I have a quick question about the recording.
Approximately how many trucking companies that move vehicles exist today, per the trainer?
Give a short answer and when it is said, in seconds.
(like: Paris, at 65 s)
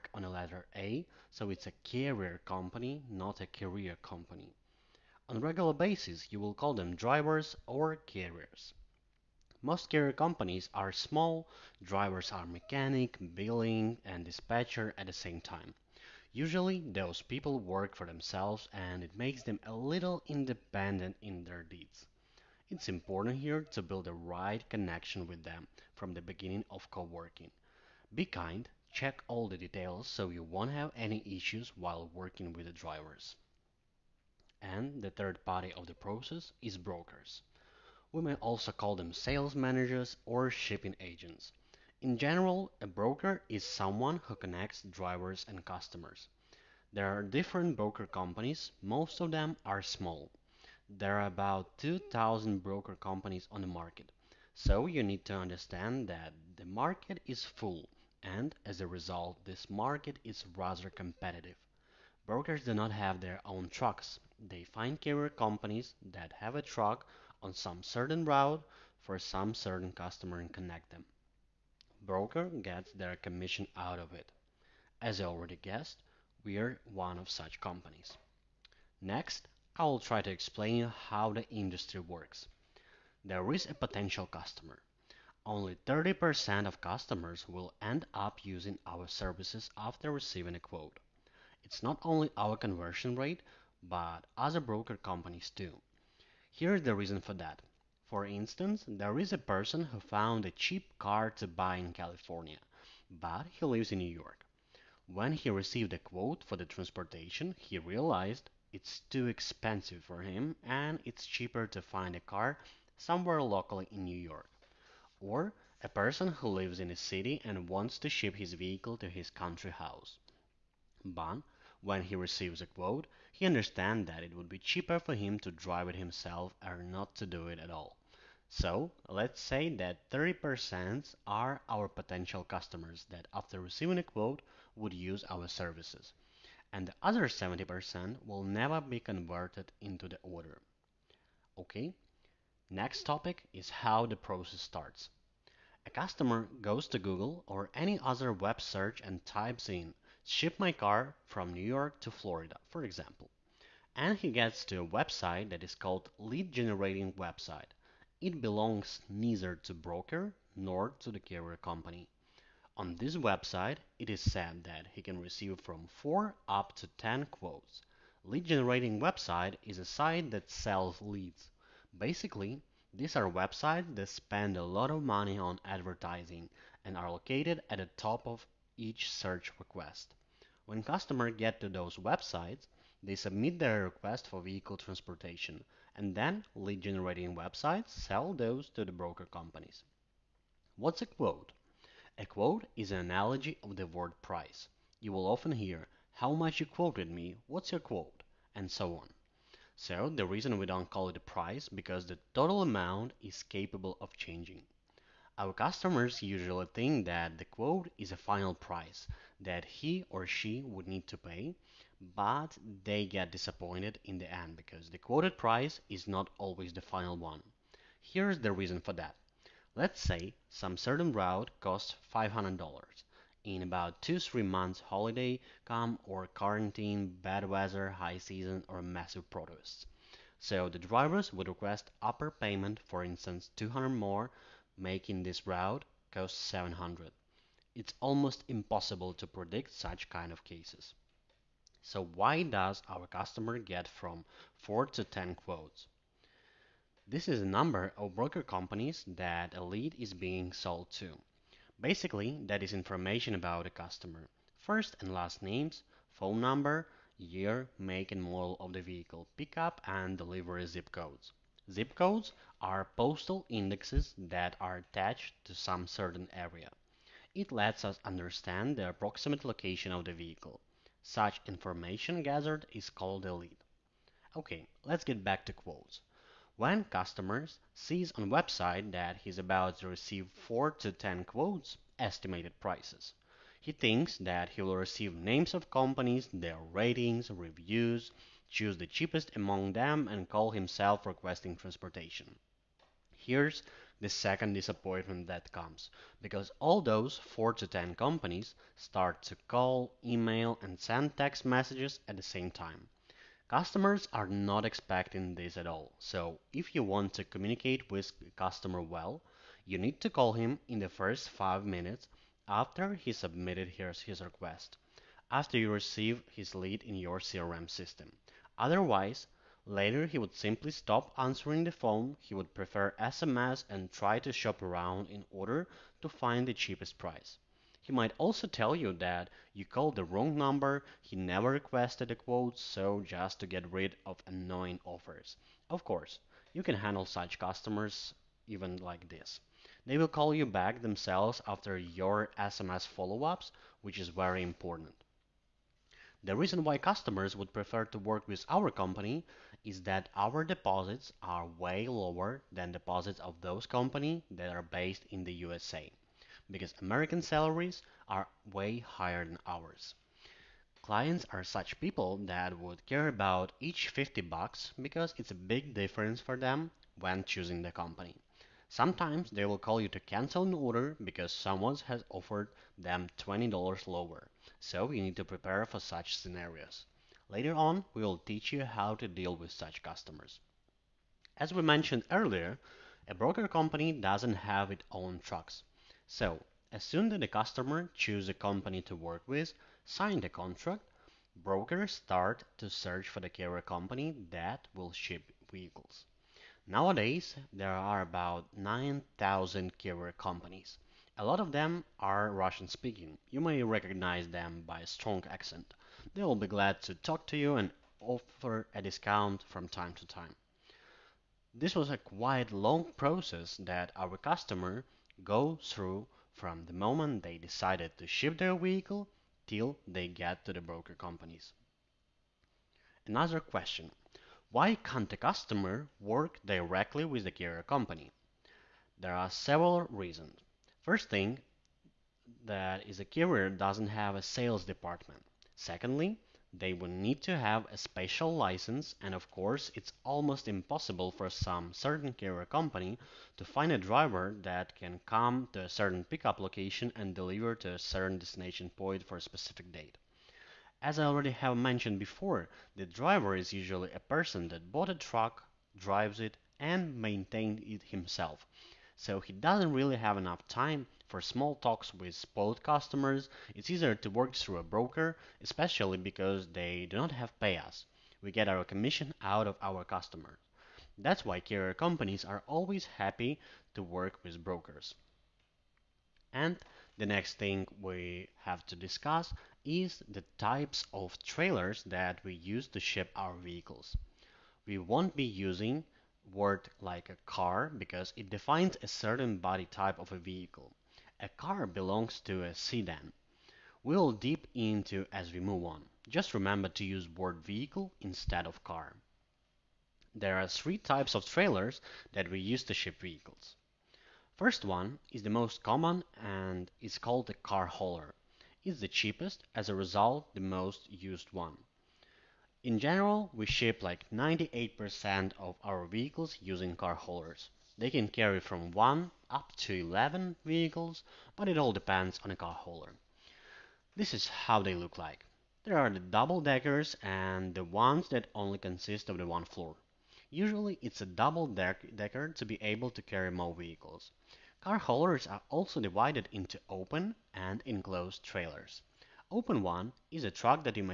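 9,000, at 398 s.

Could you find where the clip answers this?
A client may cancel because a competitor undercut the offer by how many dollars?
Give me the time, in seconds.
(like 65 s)
373 s.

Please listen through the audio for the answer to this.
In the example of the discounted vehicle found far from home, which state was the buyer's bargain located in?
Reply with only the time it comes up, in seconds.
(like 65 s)
101 s.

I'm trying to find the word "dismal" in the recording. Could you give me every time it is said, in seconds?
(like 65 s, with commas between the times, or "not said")
not said.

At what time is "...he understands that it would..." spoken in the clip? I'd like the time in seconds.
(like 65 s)
123 s.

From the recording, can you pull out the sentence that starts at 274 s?
Okay, let's get back to quotes.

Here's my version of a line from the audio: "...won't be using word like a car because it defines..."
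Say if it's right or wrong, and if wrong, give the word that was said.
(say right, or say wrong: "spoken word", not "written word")
right.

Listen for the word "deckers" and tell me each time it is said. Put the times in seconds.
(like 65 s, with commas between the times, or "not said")
525 s, 531 s.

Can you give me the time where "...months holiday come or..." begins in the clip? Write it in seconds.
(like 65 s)
224 s.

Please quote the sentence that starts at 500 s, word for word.
There are three types of trailers that we use to ship vehicles.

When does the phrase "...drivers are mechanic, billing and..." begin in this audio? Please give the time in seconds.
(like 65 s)
11 s.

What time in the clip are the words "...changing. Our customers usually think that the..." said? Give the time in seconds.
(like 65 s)
204 s.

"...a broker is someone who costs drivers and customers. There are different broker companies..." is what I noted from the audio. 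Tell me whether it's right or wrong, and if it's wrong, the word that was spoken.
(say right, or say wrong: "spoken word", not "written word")
wrong: "connects", not "costs".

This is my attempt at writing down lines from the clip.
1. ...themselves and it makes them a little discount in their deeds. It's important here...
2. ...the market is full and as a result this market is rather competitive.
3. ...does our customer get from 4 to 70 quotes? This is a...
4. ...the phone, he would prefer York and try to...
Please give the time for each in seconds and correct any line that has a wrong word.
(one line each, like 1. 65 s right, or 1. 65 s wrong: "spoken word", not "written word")
1. 18 s wrong: "independent", not "discount"
2. 56 s right
3. 242 s wrong: "10", not "70"
4. 321 s wrong: "SMS", not "York".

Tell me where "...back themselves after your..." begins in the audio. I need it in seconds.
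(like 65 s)
340 s.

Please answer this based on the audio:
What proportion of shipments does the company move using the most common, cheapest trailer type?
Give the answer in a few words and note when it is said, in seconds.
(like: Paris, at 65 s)
98%, at 514 s.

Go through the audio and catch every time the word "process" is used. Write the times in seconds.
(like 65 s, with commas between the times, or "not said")
35 s, 144 s, 412 s.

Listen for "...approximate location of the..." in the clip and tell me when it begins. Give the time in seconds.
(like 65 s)
268 s.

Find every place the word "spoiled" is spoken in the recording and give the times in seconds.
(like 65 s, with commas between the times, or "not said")
462 s.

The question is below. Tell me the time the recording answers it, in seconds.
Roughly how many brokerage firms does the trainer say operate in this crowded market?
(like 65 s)
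51 s.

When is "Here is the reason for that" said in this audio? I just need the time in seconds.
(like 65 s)
96 s.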